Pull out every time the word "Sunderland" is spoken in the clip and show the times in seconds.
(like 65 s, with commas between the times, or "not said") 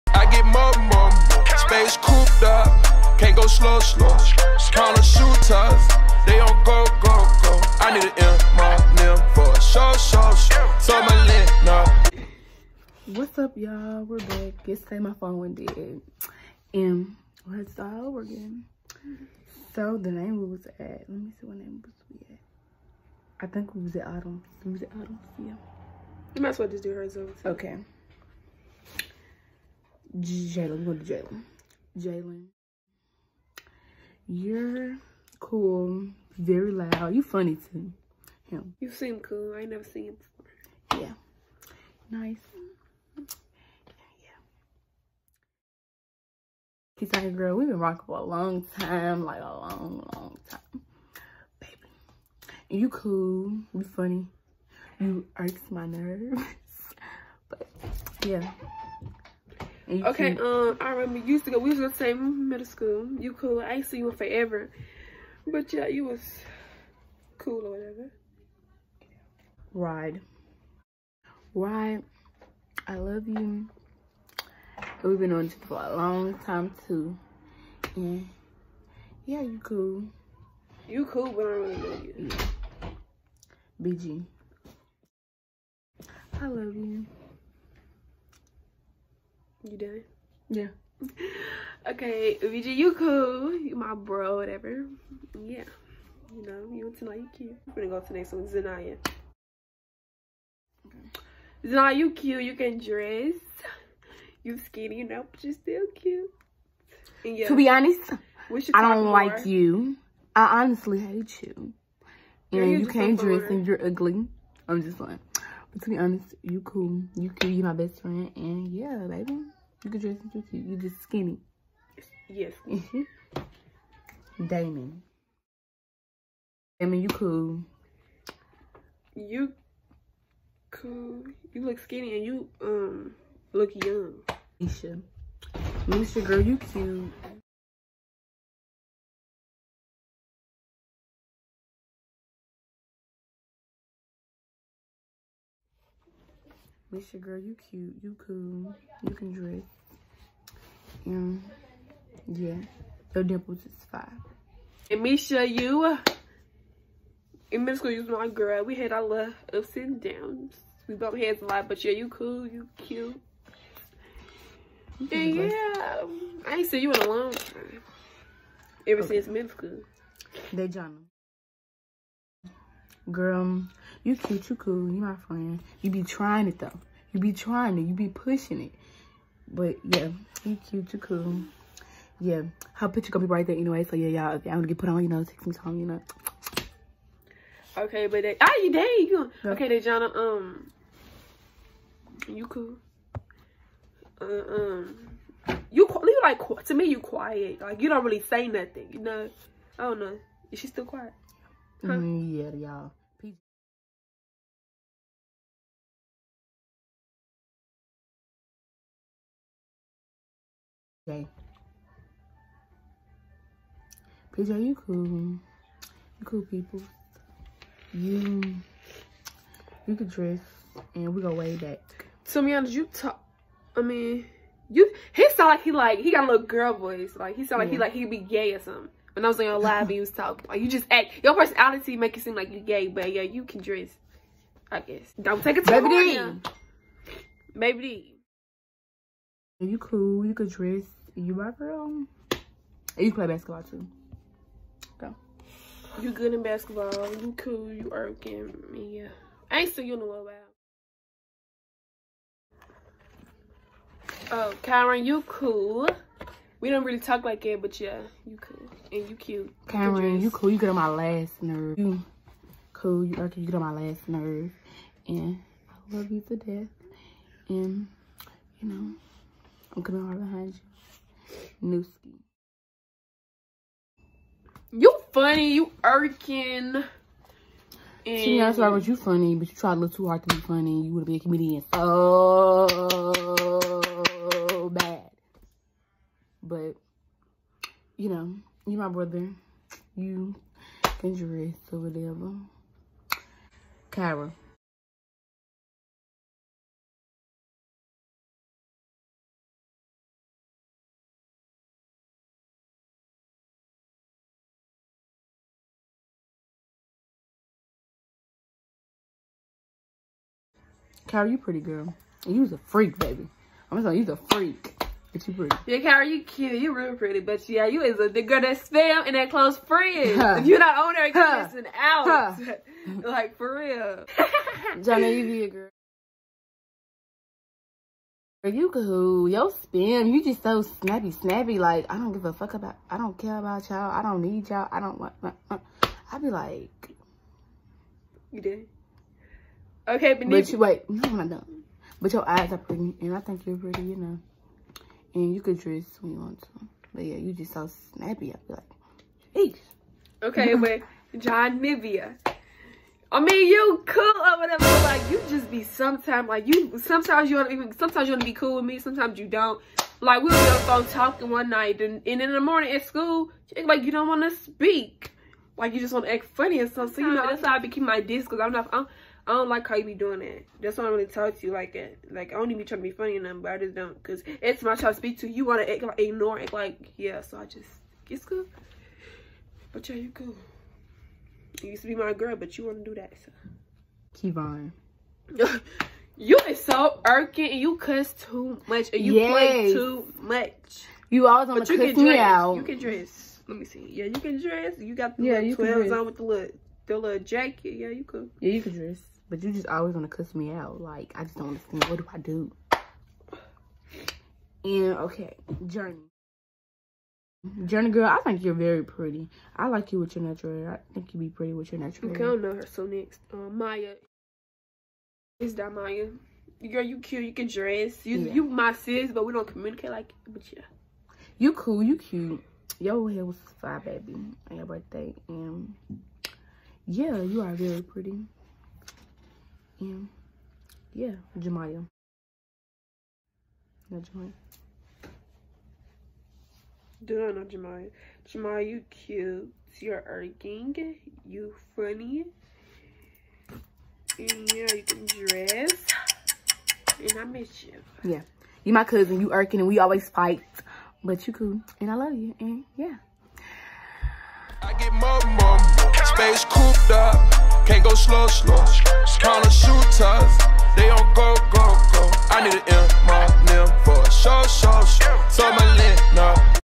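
not said.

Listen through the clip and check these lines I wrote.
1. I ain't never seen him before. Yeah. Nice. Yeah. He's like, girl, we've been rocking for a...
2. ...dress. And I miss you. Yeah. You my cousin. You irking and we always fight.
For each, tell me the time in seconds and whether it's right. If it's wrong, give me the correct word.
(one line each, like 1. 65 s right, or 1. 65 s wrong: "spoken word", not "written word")
1. 39 s right
2. 445 s right.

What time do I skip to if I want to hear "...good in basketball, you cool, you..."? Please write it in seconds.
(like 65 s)
246 s.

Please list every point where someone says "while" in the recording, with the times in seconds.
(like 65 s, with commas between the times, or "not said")
250 s.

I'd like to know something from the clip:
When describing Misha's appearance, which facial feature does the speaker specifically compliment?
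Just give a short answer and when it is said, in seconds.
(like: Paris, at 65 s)
Dimples, at 153 s.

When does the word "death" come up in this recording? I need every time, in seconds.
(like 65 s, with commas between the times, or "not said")
266 s.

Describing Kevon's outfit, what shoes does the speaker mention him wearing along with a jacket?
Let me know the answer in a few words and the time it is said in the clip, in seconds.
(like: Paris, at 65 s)
12s, at 395 s.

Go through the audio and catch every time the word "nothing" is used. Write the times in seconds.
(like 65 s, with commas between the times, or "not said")
198 s, 373 s.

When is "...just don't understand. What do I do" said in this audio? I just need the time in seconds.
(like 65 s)
401 s.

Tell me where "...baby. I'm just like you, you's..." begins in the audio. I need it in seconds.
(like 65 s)
312 s.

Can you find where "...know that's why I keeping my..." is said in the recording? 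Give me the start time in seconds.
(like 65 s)
367 s.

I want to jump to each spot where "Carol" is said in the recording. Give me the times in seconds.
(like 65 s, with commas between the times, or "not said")
311 s, 315 s.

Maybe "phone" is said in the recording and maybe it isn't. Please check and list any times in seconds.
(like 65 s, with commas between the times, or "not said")
15 s, 360 s.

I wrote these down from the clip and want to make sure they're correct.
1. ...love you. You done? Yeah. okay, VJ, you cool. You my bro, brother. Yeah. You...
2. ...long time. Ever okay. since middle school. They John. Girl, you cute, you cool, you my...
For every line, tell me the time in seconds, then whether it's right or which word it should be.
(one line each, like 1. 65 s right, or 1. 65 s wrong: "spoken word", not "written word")
1. 86 s wrong: "whatever", not "brother"
2. 167 s right.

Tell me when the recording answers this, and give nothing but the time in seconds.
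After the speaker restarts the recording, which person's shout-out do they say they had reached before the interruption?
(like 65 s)
24 s.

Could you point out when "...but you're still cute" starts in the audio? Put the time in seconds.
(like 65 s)
105 s.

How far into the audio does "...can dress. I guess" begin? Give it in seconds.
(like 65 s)
233 s.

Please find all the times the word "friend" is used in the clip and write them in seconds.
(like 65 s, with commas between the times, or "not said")
118 s, 175 s, 319 s.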